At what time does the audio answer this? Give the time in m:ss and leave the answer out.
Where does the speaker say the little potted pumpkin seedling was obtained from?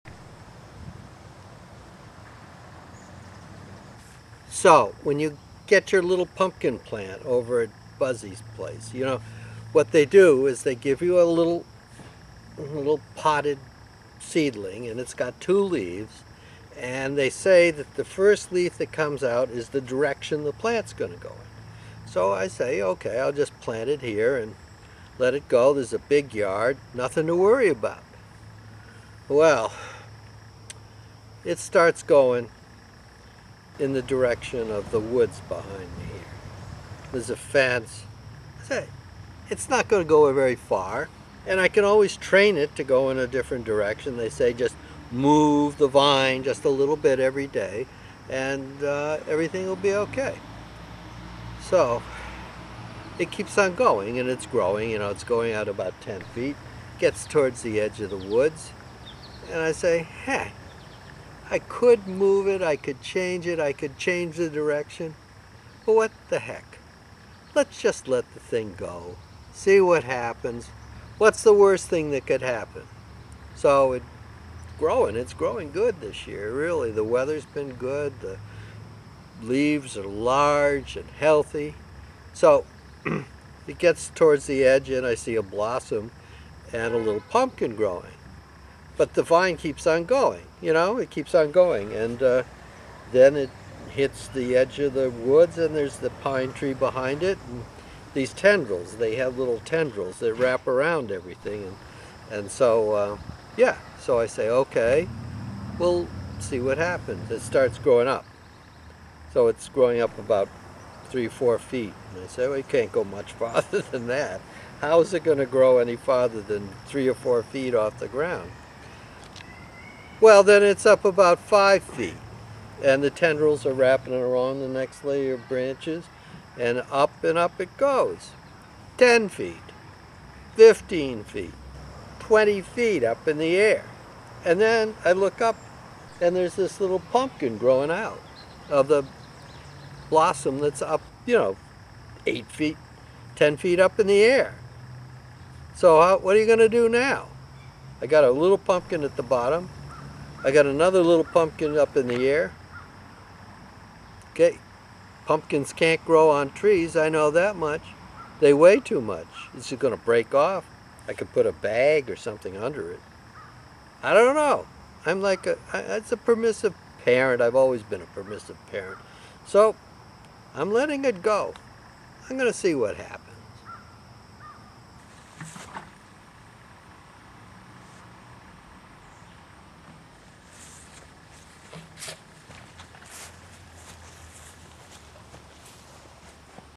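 0:07.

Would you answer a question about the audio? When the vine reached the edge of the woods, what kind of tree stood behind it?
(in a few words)
pine tree.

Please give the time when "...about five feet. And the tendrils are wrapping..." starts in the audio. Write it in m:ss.
2:01.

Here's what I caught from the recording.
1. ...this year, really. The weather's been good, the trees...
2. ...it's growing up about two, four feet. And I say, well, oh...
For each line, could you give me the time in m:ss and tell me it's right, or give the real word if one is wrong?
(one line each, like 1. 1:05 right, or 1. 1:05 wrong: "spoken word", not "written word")
1. 1:15 wrong: "leaves", not "trees"
2. 1:49 wrong: "three", not "two".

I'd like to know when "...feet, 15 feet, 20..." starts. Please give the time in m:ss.
2:09.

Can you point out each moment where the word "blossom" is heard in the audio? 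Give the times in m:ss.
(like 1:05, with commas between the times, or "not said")
1:25, 2:20.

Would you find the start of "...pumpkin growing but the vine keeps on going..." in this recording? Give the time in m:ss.
1:27.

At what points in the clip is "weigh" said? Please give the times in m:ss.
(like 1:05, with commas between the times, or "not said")
2:38.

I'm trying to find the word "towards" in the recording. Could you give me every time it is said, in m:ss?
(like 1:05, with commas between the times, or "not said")
0:57, 1:24.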